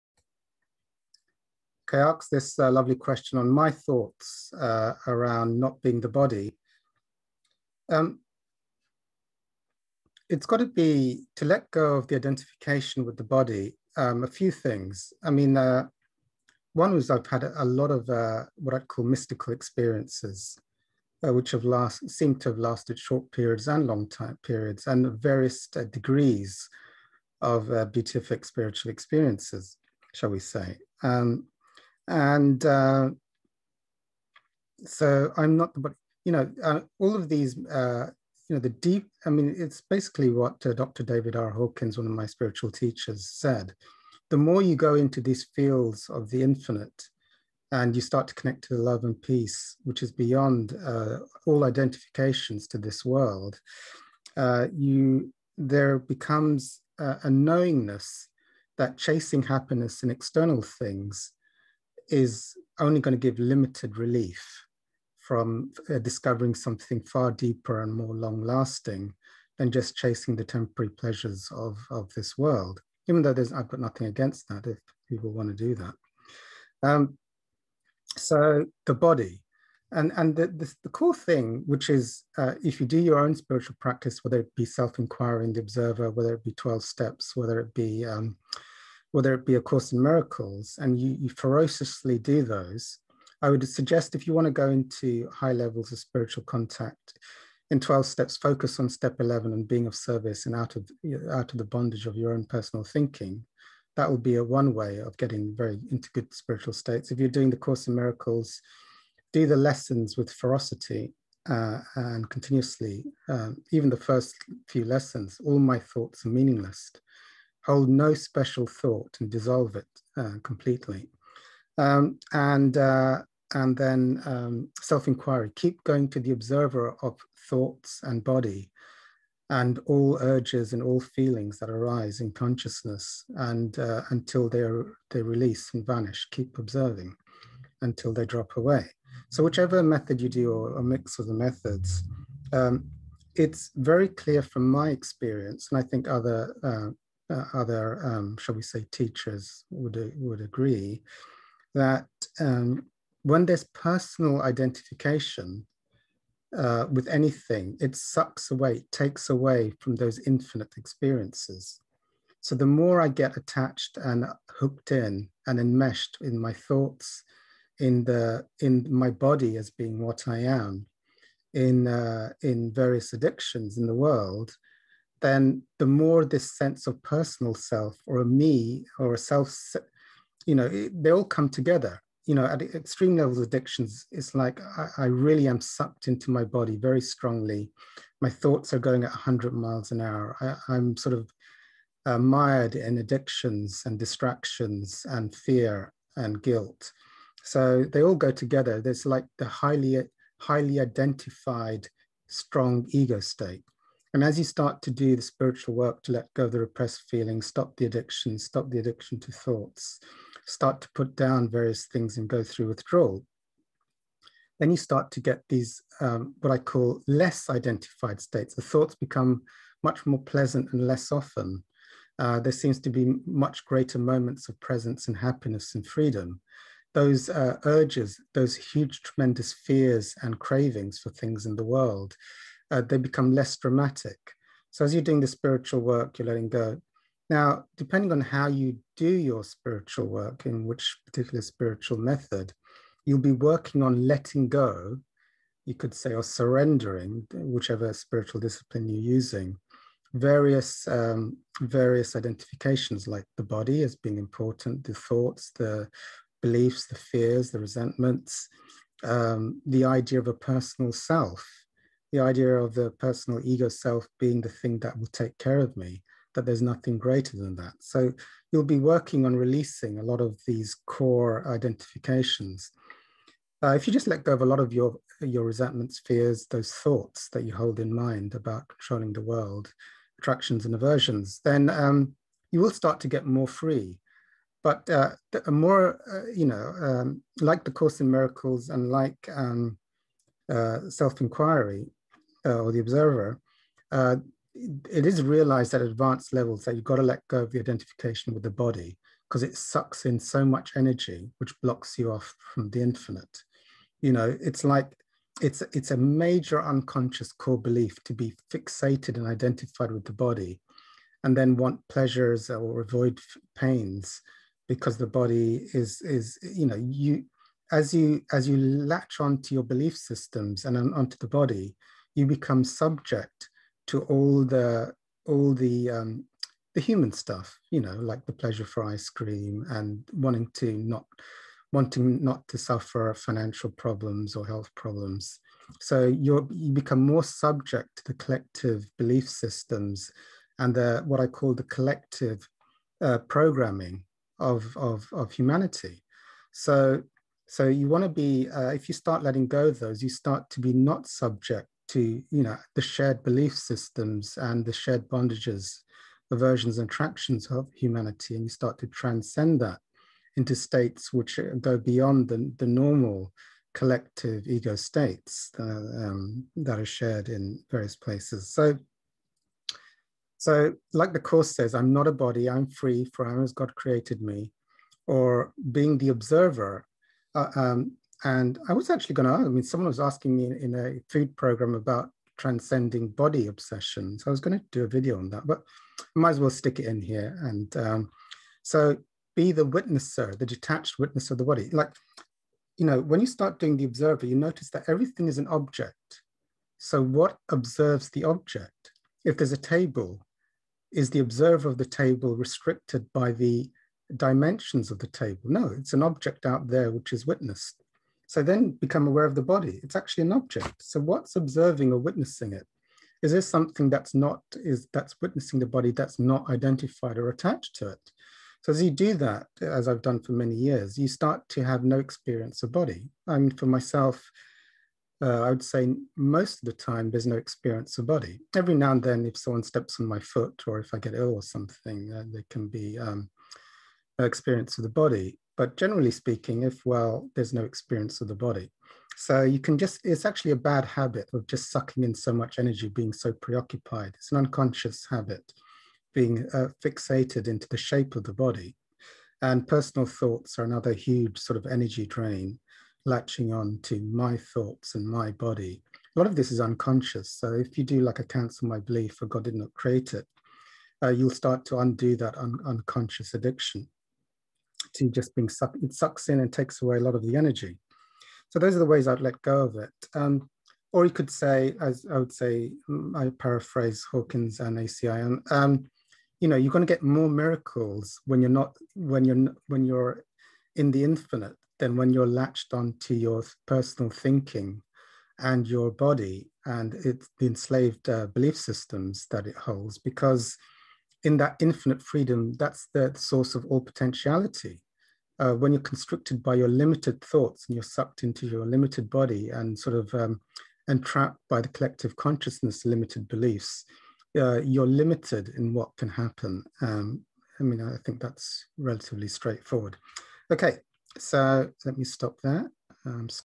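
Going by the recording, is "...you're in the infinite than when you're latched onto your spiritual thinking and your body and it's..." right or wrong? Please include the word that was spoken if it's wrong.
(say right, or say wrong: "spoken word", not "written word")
wrong: "personal", not "spiritual".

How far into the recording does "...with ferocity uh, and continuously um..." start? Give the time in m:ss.
1:50.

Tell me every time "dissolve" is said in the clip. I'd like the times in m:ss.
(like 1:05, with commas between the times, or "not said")
1:59.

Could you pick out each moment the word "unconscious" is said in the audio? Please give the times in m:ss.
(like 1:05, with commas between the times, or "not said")
5:06, 7:24, 7:36, 7:42.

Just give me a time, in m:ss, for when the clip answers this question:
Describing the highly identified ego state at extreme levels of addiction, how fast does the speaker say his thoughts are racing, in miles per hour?
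3:09.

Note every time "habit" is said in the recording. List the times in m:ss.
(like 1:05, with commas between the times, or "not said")
7:20, 7:25.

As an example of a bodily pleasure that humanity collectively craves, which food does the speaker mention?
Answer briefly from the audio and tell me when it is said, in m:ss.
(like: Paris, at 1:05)
Ice cream, at 5:28.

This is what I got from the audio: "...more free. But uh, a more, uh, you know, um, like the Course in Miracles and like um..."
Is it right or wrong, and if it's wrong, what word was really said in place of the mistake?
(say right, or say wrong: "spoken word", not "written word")
right.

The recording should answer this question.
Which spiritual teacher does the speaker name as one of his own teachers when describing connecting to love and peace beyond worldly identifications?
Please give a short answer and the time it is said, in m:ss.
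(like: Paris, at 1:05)
David R. Hawkins, at 0:40.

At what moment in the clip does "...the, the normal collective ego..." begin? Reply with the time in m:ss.
6:02.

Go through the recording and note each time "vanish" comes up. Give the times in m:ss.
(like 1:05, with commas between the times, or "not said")
2:15.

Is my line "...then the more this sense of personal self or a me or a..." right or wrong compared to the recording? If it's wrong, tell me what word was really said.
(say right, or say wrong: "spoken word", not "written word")
right.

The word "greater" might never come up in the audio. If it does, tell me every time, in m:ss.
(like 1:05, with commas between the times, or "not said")
3:43, 4:26.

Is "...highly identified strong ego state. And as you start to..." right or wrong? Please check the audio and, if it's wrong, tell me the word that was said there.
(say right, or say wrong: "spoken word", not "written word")
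right.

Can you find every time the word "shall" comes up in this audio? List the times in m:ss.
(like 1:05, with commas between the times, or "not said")
0:30, 2:28.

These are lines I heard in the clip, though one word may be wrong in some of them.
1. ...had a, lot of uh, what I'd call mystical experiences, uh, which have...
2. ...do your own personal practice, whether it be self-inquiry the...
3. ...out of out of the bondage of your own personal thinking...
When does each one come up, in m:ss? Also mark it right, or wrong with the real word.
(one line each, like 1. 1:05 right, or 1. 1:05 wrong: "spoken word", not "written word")
1. 0:17 right
2. 1:22 wrong: "spiritual", not "personal"
3. 1:40 right.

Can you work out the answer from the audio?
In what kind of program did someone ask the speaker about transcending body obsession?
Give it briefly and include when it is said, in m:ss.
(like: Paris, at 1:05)
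A food program, at 6:21.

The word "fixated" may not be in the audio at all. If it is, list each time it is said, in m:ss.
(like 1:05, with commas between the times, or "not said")
5:08, 7:26.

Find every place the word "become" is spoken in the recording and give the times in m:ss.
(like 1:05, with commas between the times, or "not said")
0:55, 3:38, 3:52, 5:22, 5:36, 6:48.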